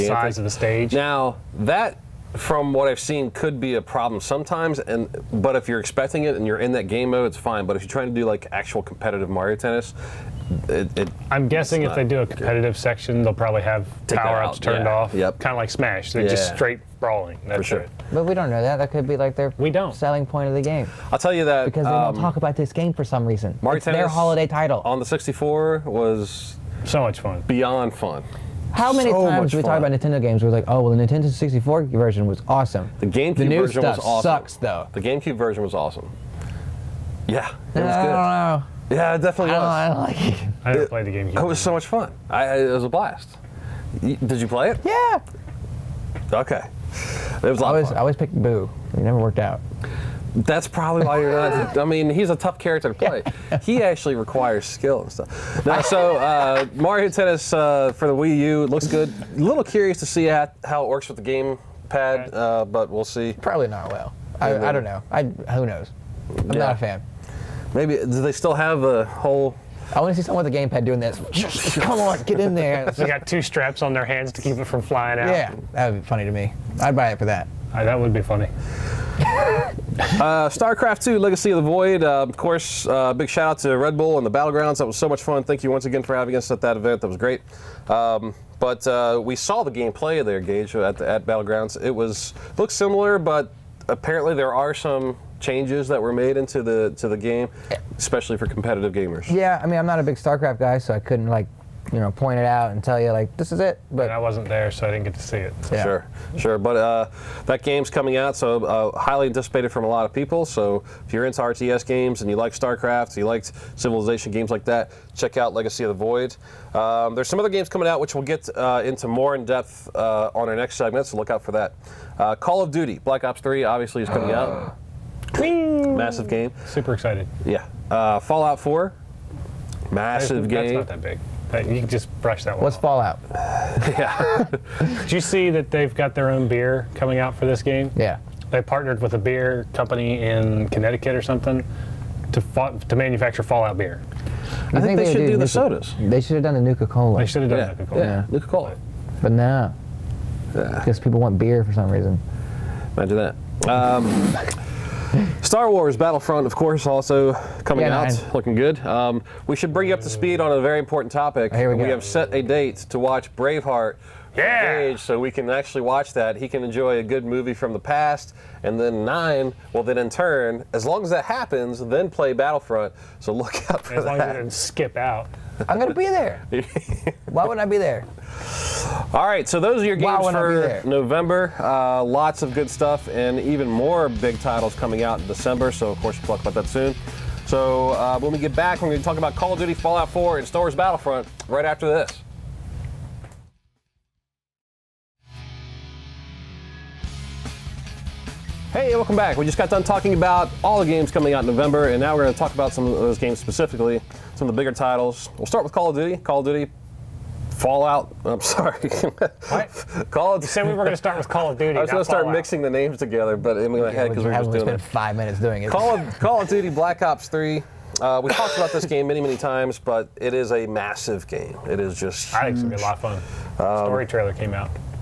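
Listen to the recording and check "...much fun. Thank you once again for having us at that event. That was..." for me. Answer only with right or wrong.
right.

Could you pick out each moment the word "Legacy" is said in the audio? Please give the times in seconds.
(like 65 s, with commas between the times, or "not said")
81 s, 115 s.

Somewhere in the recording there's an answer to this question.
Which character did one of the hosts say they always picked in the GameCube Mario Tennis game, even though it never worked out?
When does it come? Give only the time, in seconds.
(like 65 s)
48 s.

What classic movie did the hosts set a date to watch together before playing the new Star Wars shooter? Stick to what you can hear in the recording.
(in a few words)
Braveheart.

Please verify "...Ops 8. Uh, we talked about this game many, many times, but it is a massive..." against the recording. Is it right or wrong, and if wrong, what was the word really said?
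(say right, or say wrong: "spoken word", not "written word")
wrong: "3", not "8".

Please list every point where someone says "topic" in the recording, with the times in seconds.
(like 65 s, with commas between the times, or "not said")
161 s.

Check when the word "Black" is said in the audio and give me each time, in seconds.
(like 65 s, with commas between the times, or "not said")
123 s, 216 s.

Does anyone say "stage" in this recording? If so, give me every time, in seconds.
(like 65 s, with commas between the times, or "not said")
0 s.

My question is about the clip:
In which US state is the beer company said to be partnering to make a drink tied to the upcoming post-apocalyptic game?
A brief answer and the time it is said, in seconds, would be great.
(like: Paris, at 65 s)
Connecticut, at 140 s.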